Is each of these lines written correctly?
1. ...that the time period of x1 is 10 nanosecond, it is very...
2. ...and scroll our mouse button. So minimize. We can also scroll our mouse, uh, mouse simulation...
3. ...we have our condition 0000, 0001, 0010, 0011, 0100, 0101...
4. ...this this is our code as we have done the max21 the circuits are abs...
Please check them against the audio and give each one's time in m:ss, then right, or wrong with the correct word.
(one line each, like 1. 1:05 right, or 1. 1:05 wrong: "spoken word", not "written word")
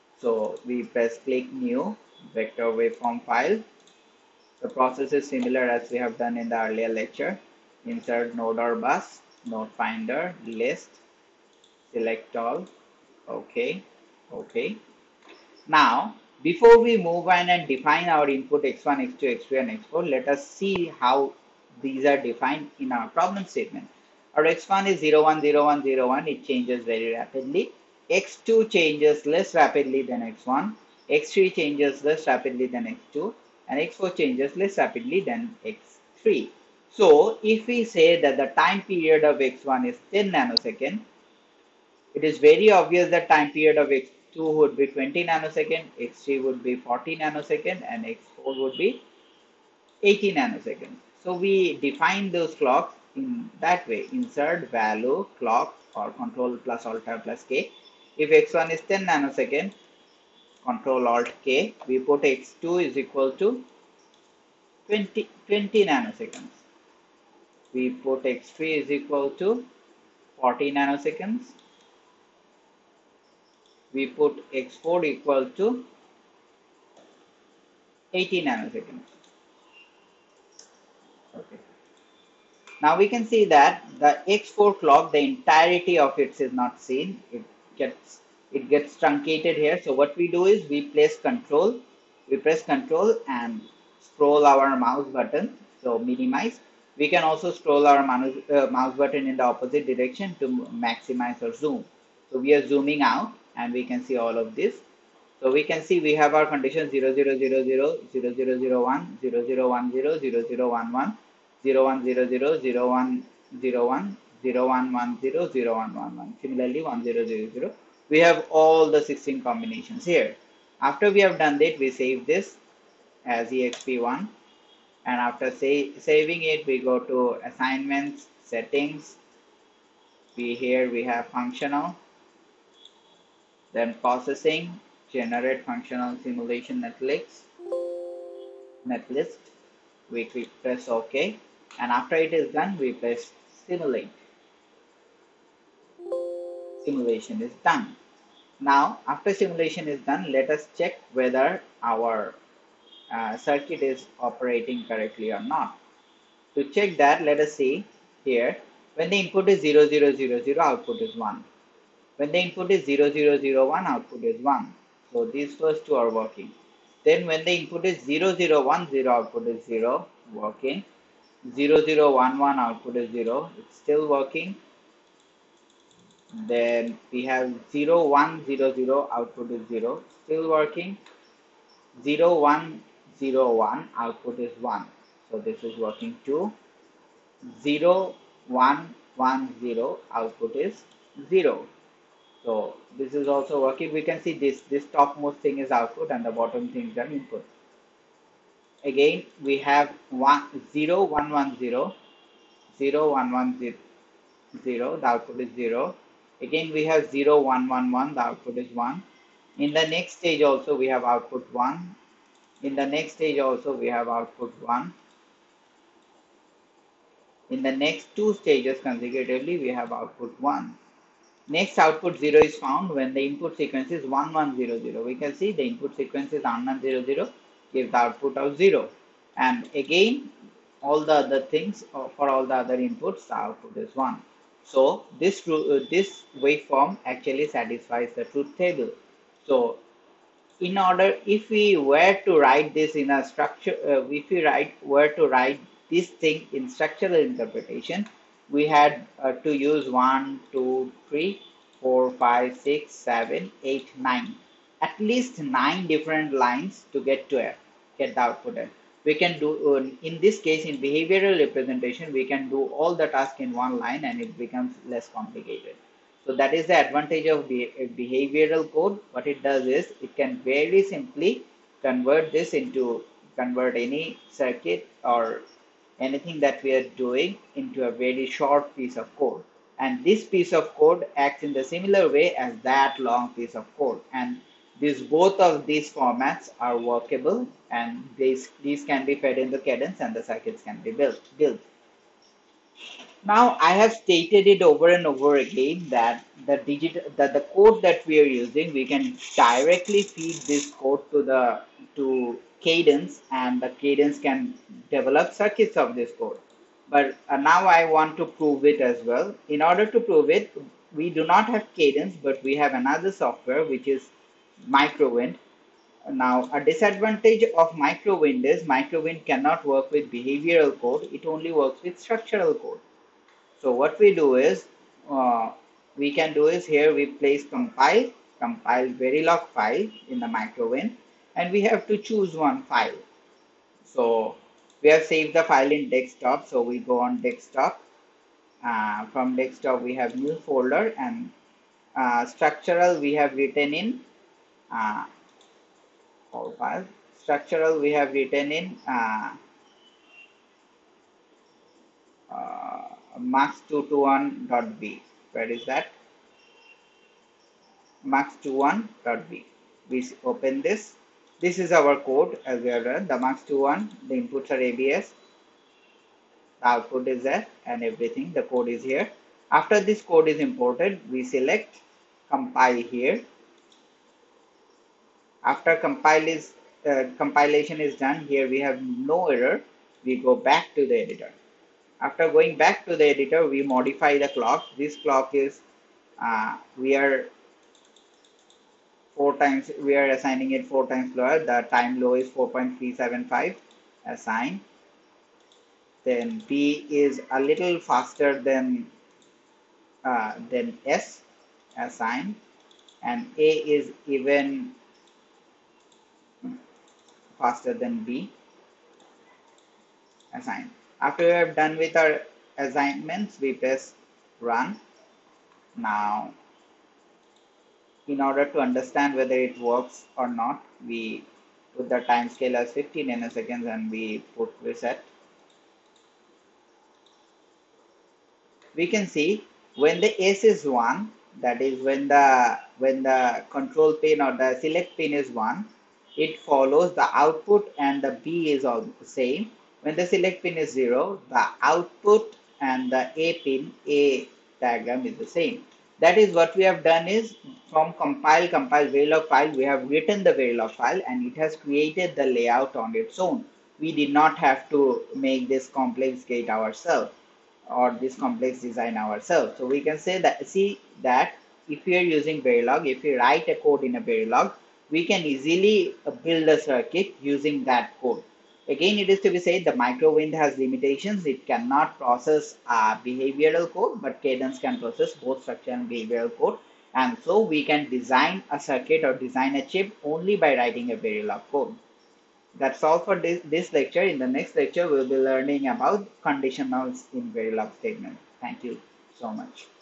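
1. 0:38 right
2. 1:33 wrong: "button", not "simulation"
3. 1:46 right
4. 6:00 wrong: "inputs", not "circuits".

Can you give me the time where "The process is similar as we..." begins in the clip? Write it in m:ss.
0:04.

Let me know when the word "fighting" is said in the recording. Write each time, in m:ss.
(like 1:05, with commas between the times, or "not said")
not said.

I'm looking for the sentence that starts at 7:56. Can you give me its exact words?
And so we can design a circuit or design a chip only by writing a Verilog code.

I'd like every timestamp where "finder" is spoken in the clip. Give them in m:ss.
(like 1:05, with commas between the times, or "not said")
0:09.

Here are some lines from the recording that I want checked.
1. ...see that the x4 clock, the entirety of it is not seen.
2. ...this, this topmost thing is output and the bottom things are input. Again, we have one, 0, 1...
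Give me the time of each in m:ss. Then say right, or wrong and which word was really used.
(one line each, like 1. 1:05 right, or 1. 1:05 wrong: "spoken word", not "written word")
1. 1:23 right
2. 3:14 right.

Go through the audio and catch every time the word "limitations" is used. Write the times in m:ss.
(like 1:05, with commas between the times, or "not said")
7:50.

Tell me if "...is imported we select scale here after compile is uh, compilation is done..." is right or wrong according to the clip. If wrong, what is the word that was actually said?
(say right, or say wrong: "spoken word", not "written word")
wrong: "compile", not "scale".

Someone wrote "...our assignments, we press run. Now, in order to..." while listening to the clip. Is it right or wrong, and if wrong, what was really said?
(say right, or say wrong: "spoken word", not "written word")
right.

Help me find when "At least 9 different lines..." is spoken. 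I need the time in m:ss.
4:14.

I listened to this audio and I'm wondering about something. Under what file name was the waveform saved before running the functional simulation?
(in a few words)
exp1.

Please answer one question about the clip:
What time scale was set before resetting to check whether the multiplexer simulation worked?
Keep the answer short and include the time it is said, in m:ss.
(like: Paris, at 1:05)
15 nanoseconds, at 7:02.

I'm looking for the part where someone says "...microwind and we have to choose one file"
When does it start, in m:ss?
5:30.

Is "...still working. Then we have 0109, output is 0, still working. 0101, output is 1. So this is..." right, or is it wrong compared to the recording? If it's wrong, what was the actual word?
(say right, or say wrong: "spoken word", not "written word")
wrong: "0100", not "0109".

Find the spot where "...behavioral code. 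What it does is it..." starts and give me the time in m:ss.
4:27.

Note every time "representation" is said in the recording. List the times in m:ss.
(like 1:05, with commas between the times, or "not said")
4:21.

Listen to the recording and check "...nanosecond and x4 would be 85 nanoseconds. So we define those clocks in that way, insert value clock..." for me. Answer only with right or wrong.
wrong.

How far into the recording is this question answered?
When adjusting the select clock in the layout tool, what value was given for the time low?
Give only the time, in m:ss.
6:32.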